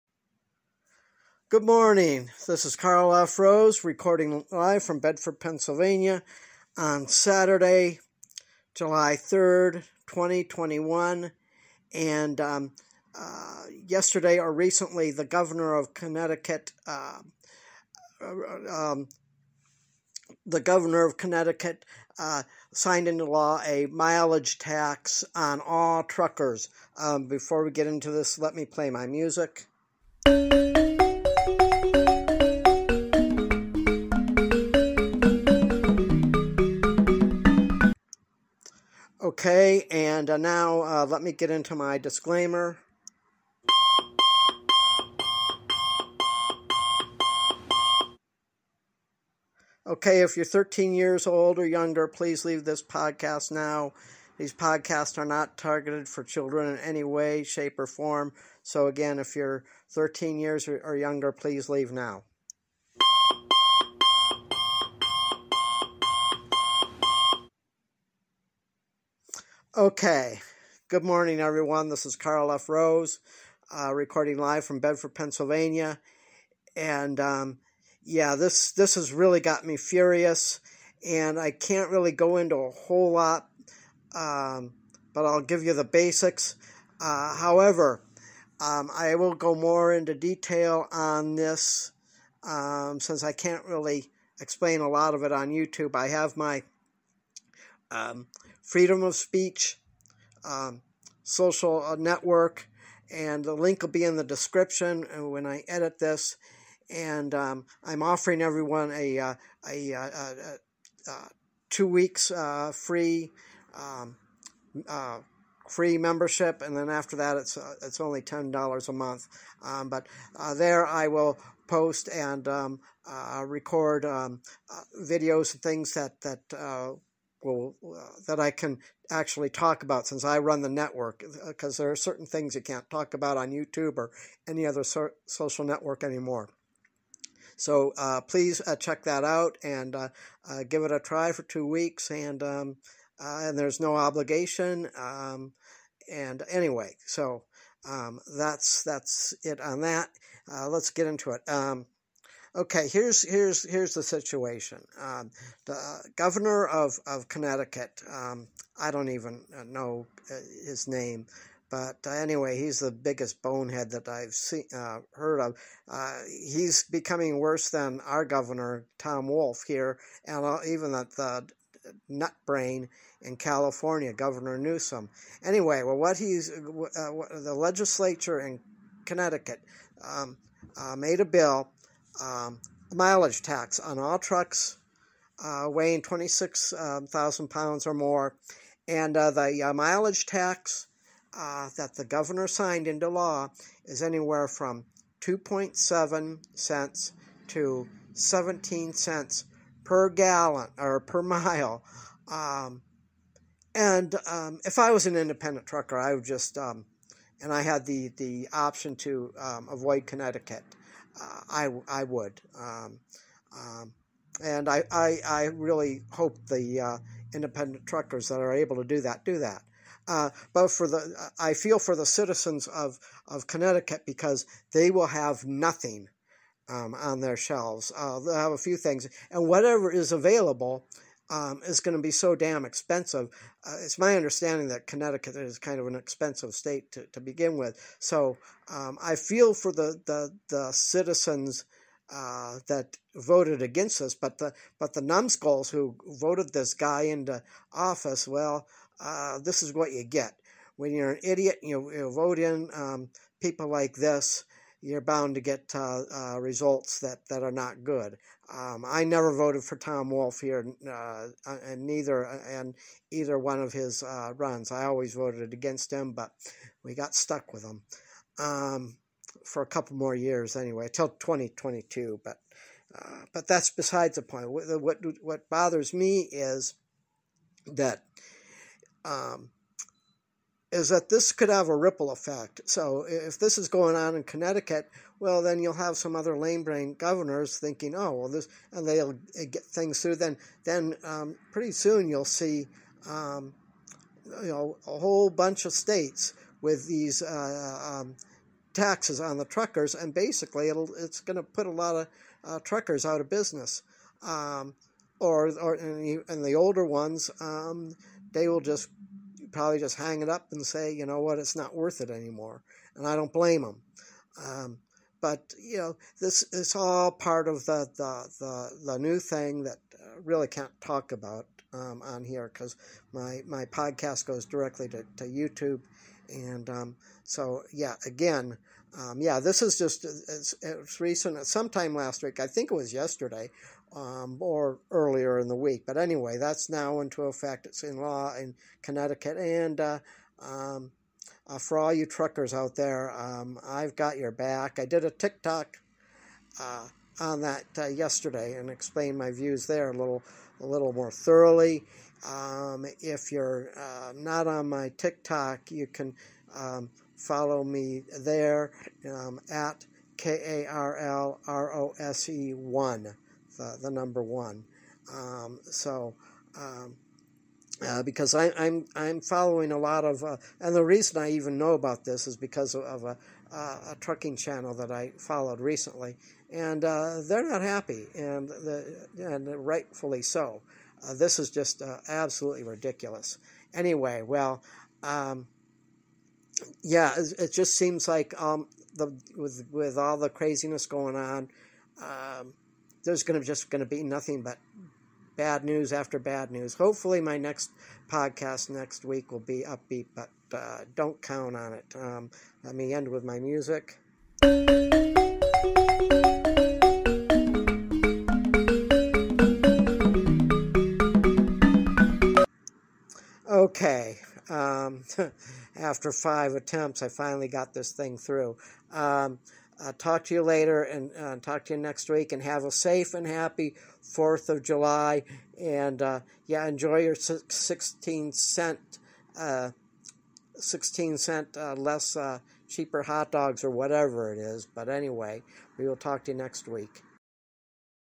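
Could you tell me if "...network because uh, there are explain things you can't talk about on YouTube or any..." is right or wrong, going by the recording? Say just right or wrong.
wrong.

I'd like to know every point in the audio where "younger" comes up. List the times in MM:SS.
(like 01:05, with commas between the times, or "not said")
00:51, 01:00.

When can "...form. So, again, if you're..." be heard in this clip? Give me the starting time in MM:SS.
00:57.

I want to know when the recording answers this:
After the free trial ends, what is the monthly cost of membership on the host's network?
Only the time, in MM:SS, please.
01:58.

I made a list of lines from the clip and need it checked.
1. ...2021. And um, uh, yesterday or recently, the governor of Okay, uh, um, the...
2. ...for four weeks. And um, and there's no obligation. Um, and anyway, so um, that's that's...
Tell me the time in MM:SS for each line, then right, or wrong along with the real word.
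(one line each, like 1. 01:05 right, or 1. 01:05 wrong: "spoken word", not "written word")
1. 00:10 wrong: "Connecticut", not "Okay"
2. 02:21 wrong: "two", not "four".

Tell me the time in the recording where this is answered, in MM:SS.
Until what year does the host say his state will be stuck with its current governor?
04:31.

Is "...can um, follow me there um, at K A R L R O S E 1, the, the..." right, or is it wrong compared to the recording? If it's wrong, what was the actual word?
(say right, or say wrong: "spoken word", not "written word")
right.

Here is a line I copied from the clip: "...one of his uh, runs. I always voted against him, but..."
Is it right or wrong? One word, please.
right.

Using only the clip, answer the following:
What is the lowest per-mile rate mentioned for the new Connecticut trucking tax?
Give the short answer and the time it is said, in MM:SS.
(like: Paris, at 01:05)
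2.7 cents, at 03:15.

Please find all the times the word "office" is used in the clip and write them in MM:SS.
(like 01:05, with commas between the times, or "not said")
04:07.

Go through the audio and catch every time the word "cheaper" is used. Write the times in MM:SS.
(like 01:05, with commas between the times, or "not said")
07:12.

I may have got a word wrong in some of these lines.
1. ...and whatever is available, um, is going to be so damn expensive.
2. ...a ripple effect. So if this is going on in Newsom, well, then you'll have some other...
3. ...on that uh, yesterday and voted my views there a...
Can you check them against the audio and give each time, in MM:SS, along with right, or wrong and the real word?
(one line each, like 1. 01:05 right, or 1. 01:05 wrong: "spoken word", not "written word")
1. 03:49 right
2. 04:41 wrong: "Connecticut", not "Newsom"
3. 05:47 wrong: "explained", not "voted".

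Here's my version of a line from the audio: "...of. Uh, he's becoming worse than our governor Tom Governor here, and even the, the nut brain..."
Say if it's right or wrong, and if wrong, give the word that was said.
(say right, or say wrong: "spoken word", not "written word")
wrong: "Wolf", not "Governor".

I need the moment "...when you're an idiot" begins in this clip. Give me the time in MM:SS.
04:10.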